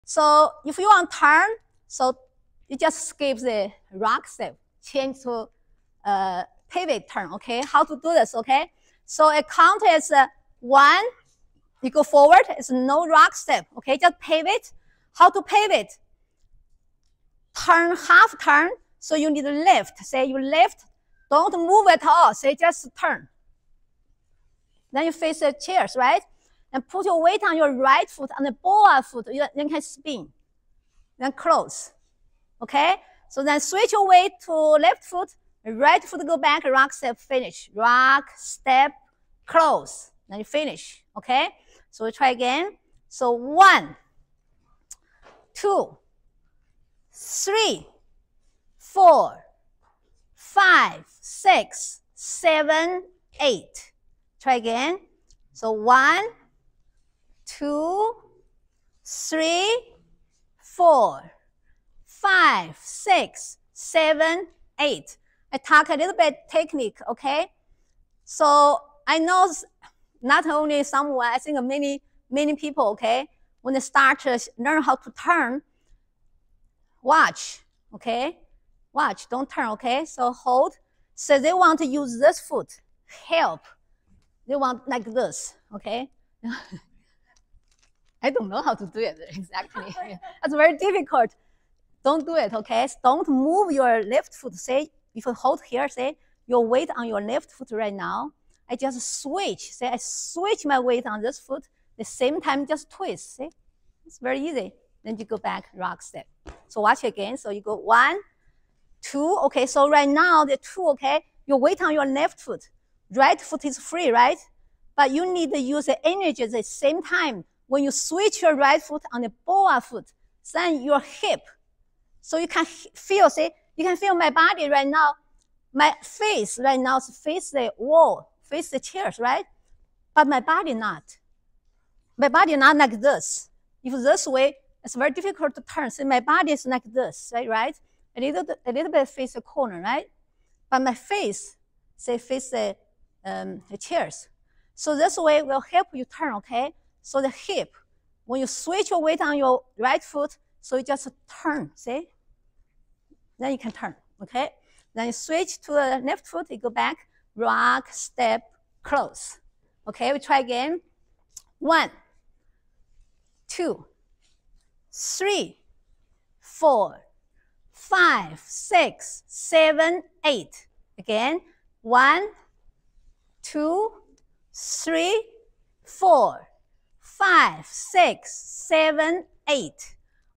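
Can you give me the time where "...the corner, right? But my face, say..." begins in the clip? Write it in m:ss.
2:19.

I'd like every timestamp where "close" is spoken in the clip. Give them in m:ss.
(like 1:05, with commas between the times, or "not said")
0:31, 0:39, 2:38.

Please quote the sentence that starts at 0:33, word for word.
So then switch your weight to left foot, right foot go back, rock step, finish.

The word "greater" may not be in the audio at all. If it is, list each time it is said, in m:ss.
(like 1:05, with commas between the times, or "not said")
not said.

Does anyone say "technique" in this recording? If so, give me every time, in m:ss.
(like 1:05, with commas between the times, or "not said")
1:06.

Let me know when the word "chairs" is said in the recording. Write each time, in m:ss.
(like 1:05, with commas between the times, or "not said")
0:25, 2:08, 2:23.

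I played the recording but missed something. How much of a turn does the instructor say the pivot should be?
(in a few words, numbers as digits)
half turn.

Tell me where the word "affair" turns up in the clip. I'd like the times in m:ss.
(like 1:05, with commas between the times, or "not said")
not said.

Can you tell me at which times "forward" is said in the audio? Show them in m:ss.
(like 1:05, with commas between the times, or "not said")
0:12.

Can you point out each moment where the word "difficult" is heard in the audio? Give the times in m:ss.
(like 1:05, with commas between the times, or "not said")
1:30, 2:15.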